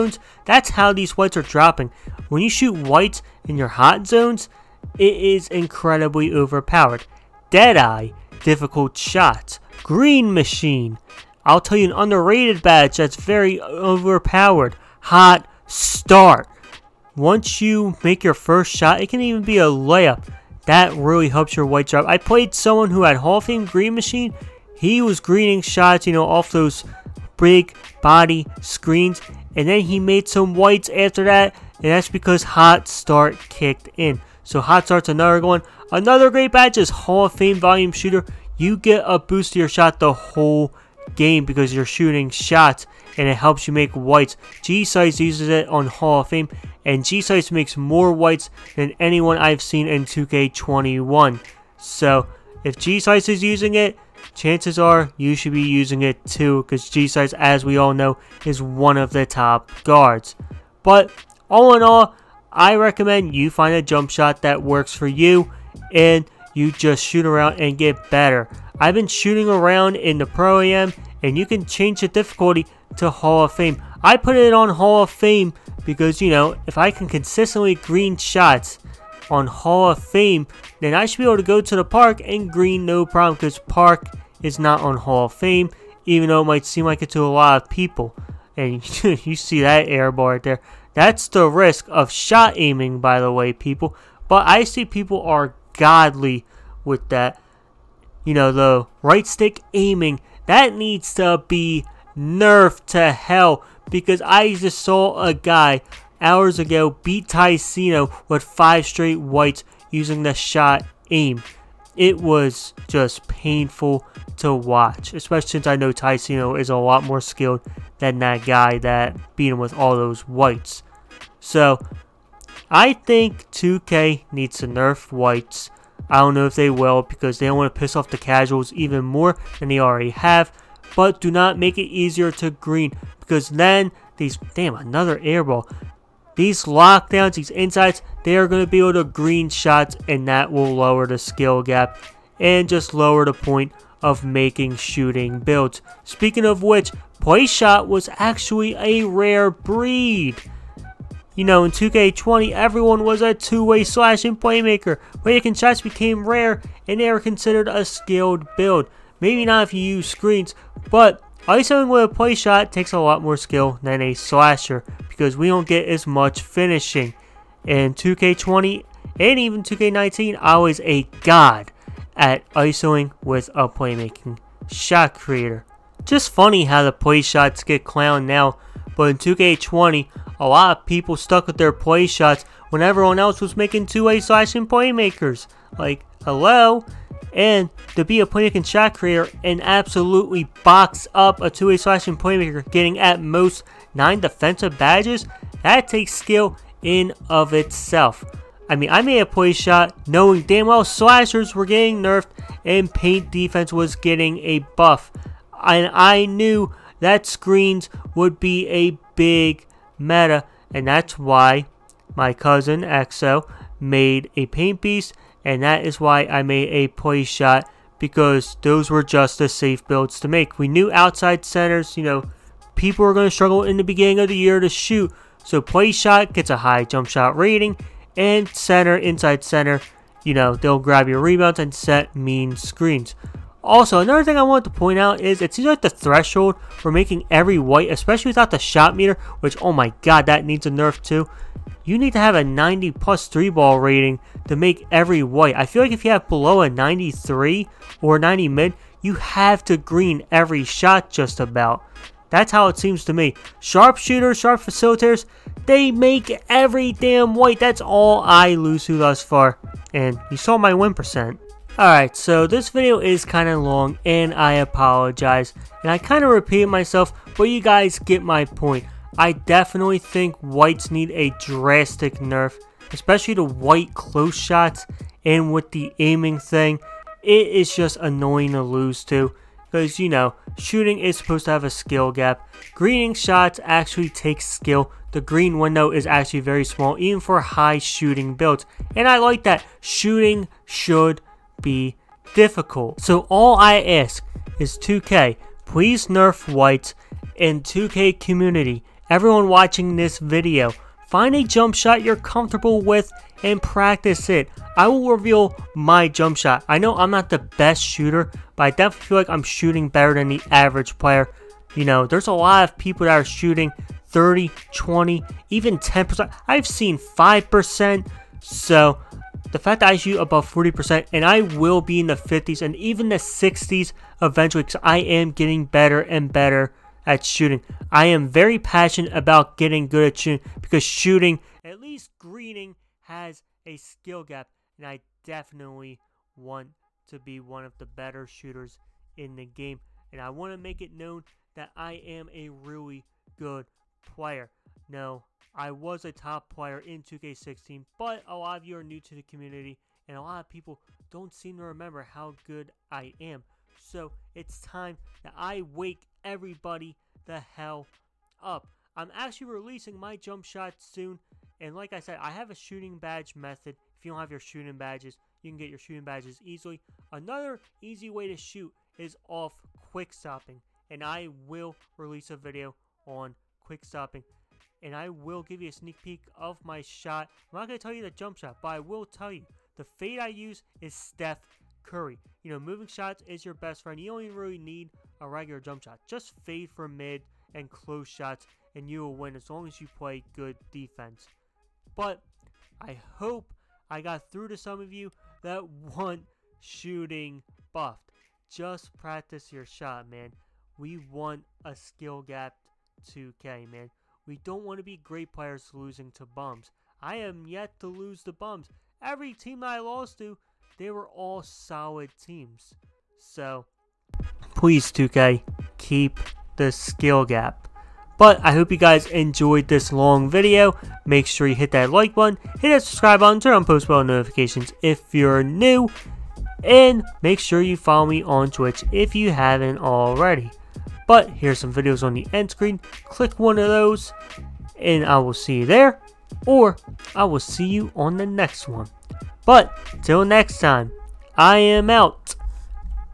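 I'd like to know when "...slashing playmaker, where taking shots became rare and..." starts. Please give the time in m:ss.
2:33.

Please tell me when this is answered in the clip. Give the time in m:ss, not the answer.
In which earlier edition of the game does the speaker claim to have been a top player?
5:47.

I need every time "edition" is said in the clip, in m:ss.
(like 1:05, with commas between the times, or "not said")
not said.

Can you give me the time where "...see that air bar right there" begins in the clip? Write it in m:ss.
1:29.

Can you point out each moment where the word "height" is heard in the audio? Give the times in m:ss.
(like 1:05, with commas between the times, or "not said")
not said.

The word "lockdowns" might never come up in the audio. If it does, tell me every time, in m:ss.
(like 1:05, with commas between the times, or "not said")
2:16.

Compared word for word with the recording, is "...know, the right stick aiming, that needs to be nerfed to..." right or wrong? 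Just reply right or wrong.
right.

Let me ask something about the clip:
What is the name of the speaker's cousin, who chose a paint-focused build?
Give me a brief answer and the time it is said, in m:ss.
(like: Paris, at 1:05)
Exo, at 3:32.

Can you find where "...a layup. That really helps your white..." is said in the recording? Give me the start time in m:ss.
0:19.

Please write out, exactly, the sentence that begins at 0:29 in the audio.
And then he made some whites after that.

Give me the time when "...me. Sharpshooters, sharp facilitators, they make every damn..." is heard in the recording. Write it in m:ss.
4:13.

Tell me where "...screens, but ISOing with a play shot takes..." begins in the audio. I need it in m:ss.
2:40.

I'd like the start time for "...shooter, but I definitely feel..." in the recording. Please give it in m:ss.
5:07.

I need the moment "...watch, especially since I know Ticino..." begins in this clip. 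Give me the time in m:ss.
1:54.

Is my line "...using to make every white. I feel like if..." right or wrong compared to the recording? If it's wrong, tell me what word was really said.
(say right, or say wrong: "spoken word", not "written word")
wrong: "rating", not "using".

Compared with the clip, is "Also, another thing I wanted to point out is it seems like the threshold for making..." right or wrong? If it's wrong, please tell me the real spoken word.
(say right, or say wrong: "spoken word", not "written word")
right.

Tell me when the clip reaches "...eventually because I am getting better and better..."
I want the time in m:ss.
5:24.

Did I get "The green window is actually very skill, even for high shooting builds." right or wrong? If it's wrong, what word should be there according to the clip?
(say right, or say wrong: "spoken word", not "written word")
wrong: "small", not "skill".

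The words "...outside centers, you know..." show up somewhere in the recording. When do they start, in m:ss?
3:40.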